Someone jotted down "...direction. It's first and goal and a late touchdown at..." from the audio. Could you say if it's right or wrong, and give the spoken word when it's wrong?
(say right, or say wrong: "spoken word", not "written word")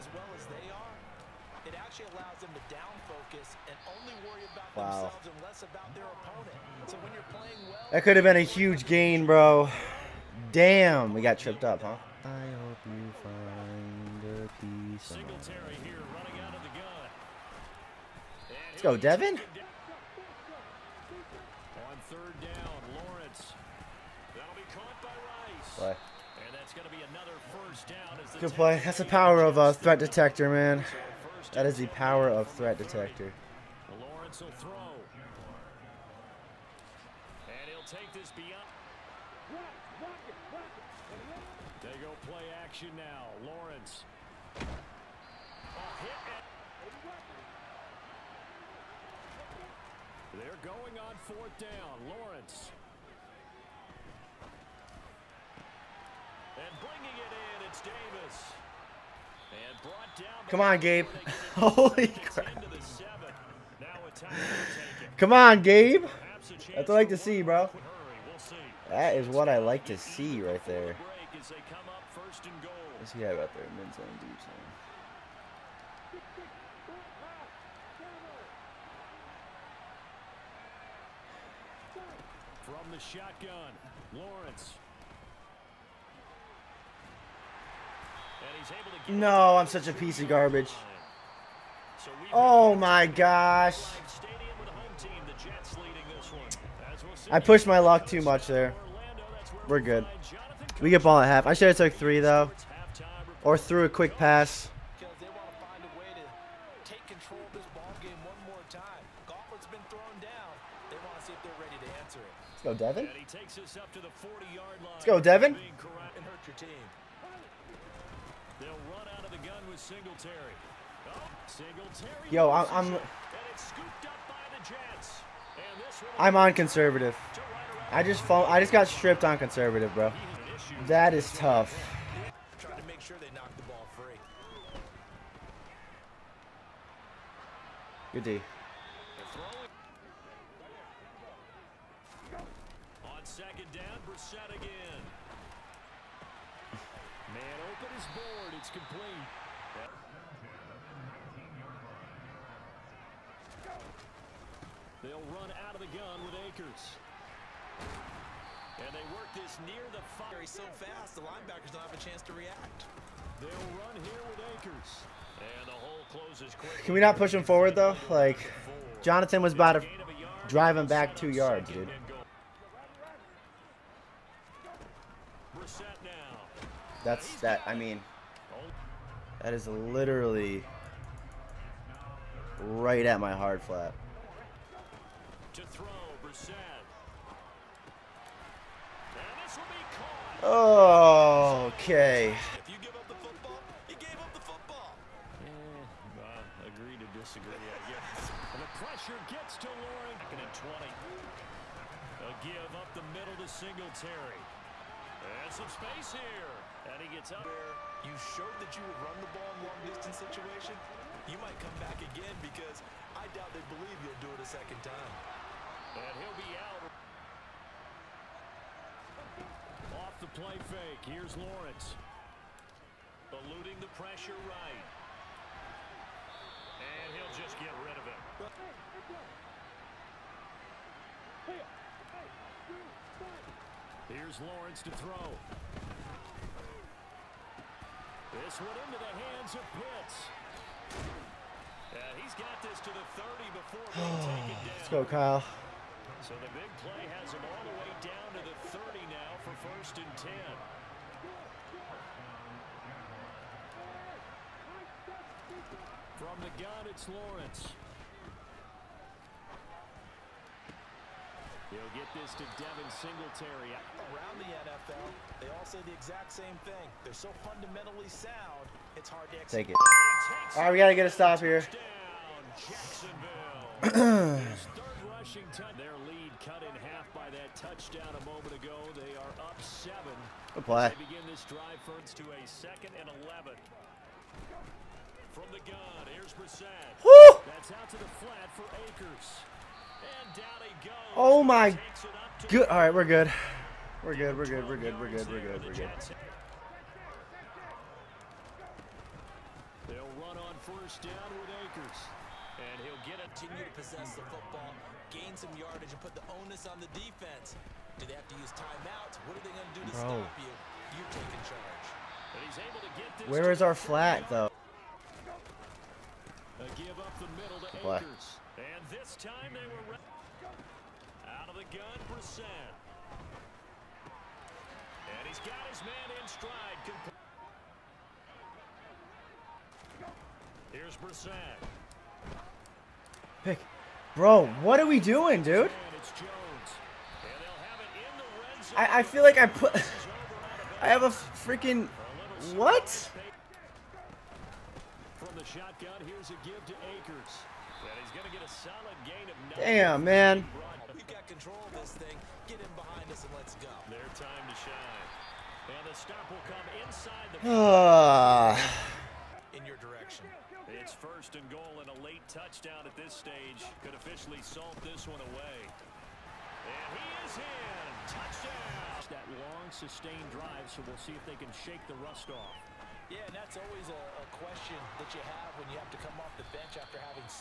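right.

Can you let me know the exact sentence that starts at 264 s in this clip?
Around the NFL, they all say the exact same thing.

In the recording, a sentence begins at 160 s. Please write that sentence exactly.
He's so fast, the linebackers don't have a chance to react.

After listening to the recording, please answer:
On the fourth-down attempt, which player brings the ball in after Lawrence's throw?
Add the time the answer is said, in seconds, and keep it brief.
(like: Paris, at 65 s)
Davis, at 57 s.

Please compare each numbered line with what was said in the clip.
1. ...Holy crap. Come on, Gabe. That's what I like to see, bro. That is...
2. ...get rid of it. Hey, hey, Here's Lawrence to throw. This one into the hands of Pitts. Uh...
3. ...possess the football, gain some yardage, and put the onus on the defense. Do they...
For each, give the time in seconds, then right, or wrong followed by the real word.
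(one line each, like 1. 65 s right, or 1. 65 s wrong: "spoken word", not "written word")
1. 61 s right
2. 227 s right
3. 303 s right.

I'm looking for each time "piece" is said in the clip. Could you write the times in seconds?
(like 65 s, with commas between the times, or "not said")
14 s, 89 s.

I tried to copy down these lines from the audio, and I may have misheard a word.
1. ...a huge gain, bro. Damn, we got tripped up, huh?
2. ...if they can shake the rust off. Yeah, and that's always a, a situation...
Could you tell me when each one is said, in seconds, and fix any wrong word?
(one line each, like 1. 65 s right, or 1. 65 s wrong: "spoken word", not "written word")
1. 8 s right
2. 371 s wrong: "question", not "situation".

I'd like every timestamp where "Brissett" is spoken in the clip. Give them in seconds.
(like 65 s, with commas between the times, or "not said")
144 s, 286 s, 322 s, 330 s.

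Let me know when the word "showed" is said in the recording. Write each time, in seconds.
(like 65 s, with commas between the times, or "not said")
208 s.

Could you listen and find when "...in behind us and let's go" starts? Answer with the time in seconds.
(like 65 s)
352 s.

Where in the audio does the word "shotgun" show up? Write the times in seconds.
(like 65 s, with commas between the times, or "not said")
82 s, 345 s.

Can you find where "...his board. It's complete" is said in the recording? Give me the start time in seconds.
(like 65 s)
147 s.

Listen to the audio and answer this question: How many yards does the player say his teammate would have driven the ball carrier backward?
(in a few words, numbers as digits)
2.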